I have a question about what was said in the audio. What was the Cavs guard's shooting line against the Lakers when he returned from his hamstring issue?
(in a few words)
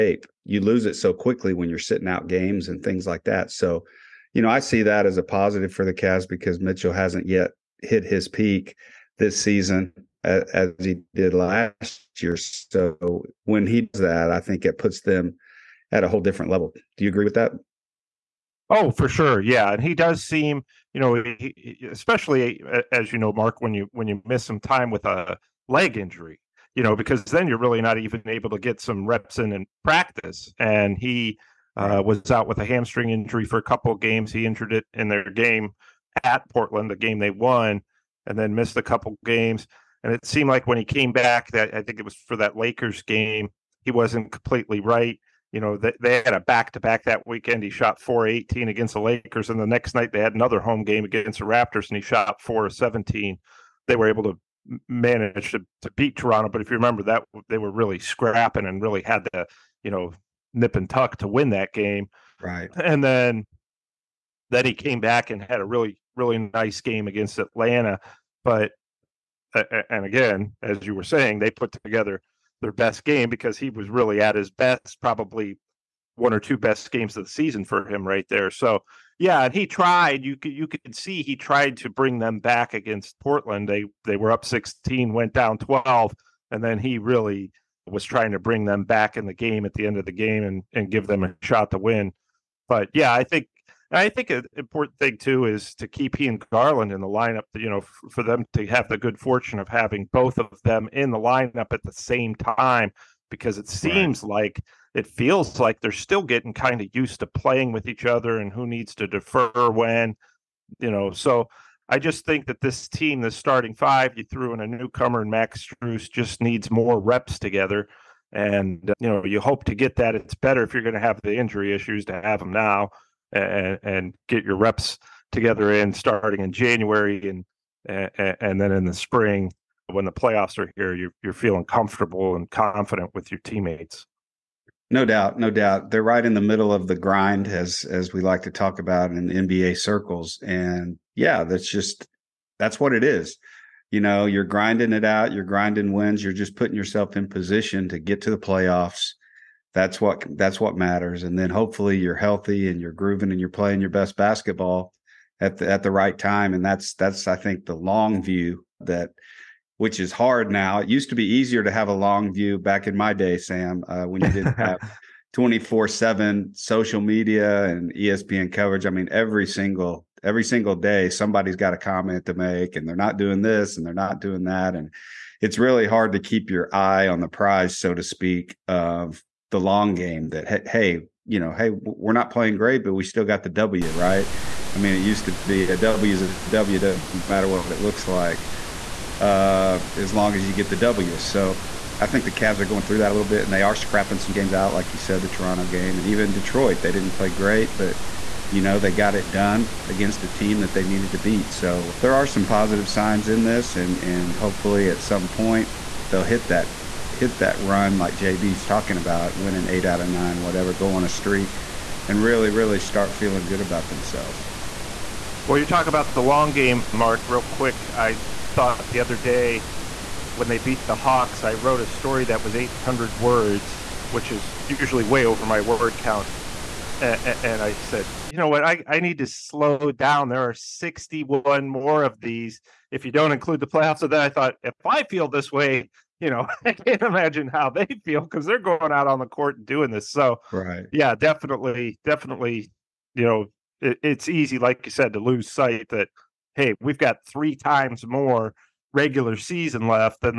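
4-18.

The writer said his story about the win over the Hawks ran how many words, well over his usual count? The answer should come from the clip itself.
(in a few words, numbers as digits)
800.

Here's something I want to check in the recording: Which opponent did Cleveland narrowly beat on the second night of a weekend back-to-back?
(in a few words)
Raptors.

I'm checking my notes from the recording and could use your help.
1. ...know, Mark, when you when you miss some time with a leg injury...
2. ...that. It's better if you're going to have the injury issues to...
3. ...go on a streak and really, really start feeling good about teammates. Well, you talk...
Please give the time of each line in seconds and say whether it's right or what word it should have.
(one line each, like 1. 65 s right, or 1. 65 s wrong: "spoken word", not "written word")
1. 23 s right
2. 119 s right
3. 210 s wrong: "themselves", not "teammates".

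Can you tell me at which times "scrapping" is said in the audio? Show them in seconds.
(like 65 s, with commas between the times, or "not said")
57 s, 193 s.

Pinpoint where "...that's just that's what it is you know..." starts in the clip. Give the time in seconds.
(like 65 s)
141 s.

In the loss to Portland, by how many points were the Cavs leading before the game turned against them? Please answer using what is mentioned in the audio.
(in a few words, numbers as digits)
16.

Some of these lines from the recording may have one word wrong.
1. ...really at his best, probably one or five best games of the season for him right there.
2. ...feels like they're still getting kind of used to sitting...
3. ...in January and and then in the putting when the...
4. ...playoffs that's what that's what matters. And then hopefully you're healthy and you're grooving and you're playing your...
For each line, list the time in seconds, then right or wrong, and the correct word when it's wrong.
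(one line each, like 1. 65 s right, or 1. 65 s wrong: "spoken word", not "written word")
1. 73 s wrong: "two", not "five"
2. 105 s wrong: "playing", not "sitting"
3. 126 s wrong: "spring", not "putting"
4. 148 s right.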